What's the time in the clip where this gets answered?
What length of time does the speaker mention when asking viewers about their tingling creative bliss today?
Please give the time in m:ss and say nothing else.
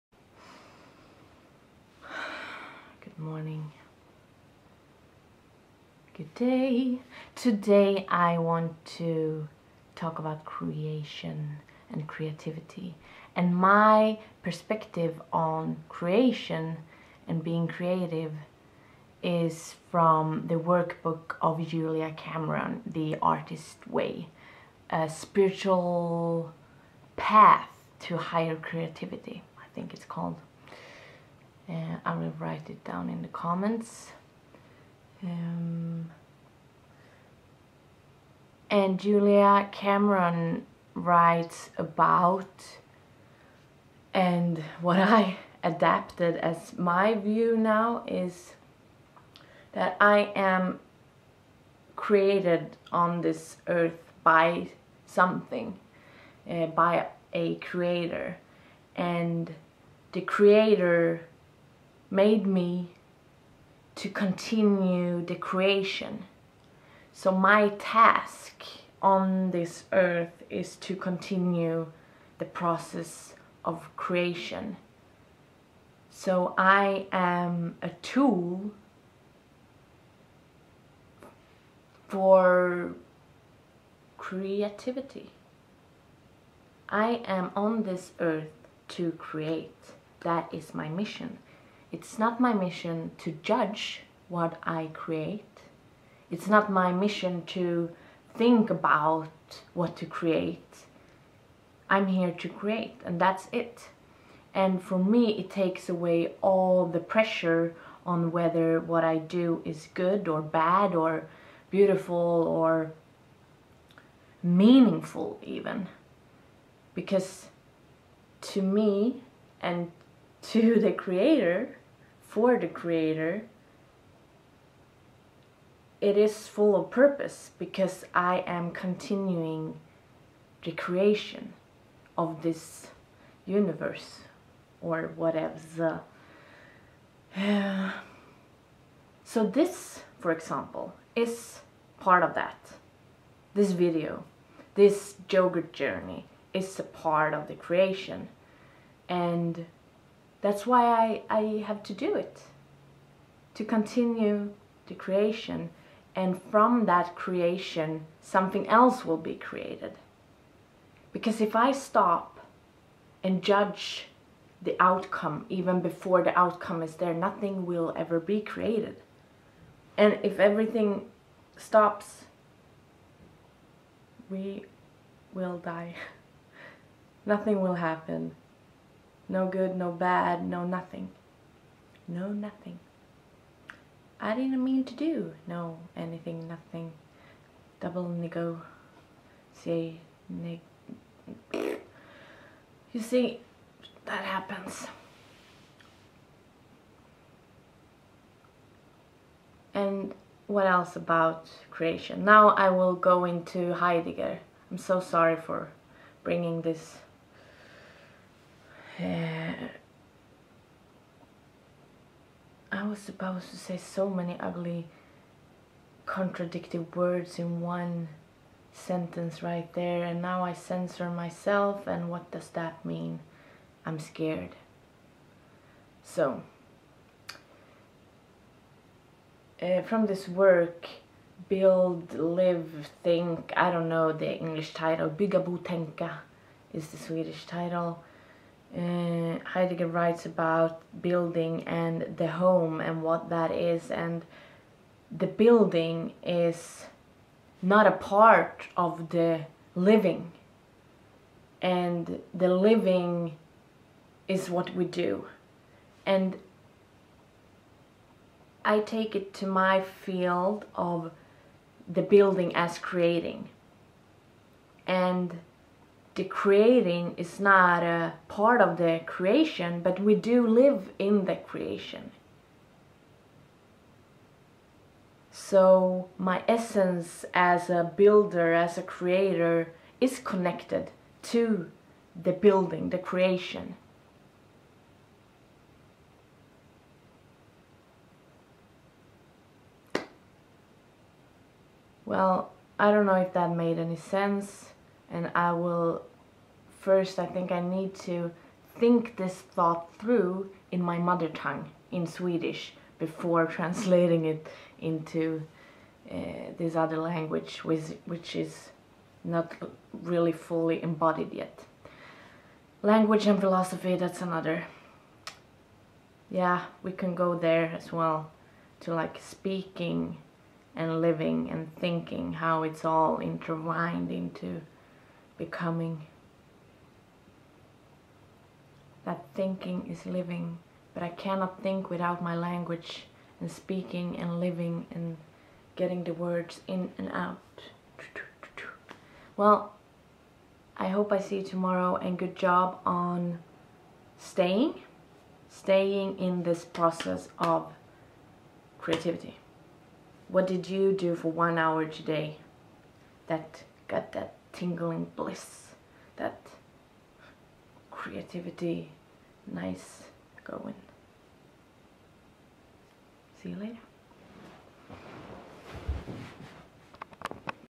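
5:51.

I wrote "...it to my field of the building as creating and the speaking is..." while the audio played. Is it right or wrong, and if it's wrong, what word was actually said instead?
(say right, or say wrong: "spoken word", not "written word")
wrong: "creating", not "speaking".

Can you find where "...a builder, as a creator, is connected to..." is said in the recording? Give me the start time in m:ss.
4:37.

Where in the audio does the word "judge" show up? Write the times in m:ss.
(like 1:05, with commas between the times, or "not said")
1:33, 2:43.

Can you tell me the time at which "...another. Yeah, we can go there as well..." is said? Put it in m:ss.
5:14.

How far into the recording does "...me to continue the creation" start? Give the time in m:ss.
1:02.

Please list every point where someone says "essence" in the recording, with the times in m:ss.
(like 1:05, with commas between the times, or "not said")
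4:36.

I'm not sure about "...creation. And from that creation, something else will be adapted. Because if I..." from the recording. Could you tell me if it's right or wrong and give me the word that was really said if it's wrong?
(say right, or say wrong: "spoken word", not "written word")
wrong: "created", not "adapted".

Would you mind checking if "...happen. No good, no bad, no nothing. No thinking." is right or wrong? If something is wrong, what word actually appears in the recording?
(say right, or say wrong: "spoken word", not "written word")
wrong: "nothing", not "thinking".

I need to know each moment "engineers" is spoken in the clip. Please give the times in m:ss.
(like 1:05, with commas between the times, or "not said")
not said.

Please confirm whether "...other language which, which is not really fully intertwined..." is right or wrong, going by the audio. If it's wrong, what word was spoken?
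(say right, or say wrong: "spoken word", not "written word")
wrong: "embodied", not "intertwined".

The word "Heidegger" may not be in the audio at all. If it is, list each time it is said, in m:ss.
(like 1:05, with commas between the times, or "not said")
3:23, 3:59.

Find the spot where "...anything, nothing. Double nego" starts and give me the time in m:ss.
3:05.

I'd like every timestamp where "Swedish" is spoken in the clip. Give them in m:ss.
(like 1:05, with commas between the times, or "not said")
3:56, 5:02.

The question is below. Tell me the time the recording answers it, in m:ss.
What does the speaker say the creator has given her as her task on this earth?
1:10.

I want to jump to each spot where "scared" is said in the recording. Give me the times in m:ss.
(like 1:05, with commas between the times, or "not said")
3:43.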